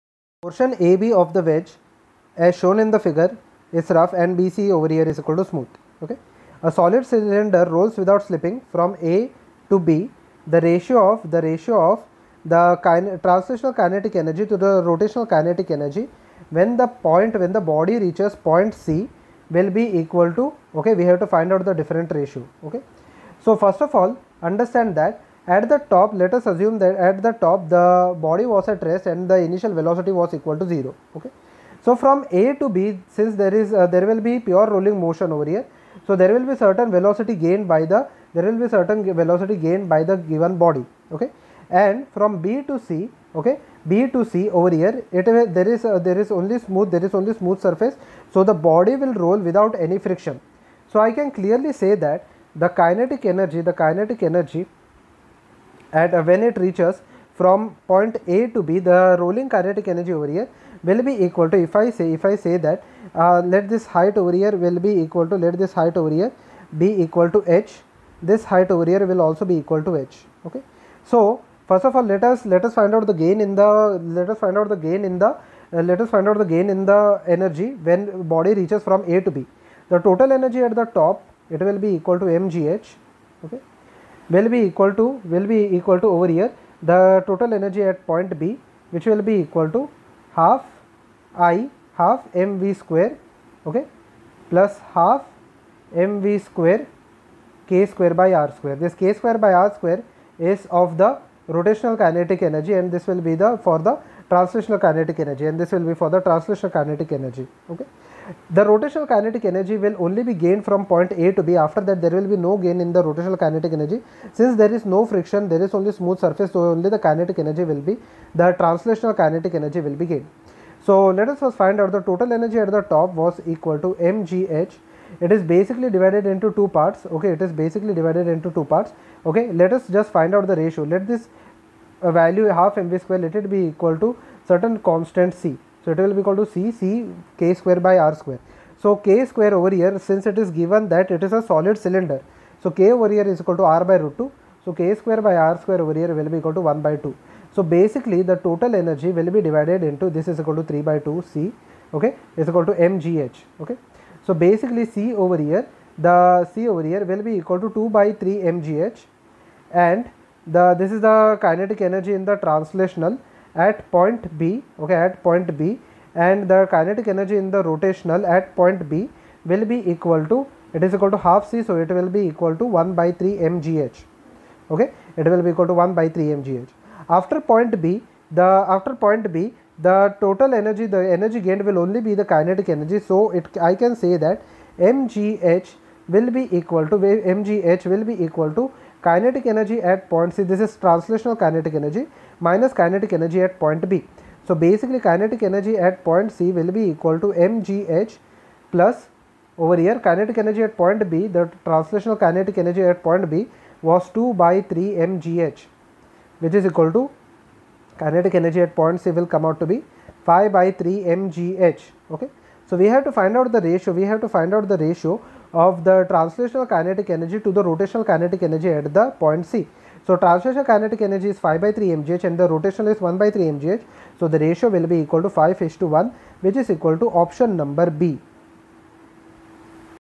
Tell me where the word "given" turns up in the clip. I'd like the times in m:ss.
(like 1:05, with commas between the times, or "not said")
0:40, 2:20.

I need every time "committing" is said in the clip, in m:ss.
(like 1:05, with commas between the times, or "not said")
not said.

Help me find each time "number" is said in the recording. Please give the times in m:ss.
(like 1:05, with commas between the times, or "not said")
3:47.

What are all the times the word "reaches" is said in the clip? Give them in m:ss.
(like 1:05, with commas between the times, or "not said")
0:17, 0:56, 1:18.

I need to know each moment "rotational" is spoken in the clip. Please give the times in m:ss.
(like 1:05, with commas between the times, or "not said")
0:14, 1:41, 1:48, 1:53, 2:47, 3:37, 3:42.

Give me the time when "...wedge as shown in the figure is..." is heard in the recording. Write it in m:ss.
0:01.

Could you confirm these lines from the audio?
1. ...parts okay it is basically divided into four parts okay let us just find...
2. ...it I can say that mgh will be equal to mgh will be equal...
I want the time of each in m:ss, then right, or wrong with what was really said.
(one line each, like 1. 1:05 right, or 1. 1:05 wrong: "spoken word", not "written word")
1. 2:06 wrong: "two", not "four"
2. 3:03 right.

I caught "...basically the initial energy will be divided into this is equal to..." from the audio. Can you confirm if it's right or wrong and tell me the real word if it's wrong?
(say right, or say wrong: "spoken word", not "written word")
wrong: "total", not "initial".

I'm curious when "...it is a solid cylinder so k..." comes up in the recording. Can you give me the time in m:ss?
2:21.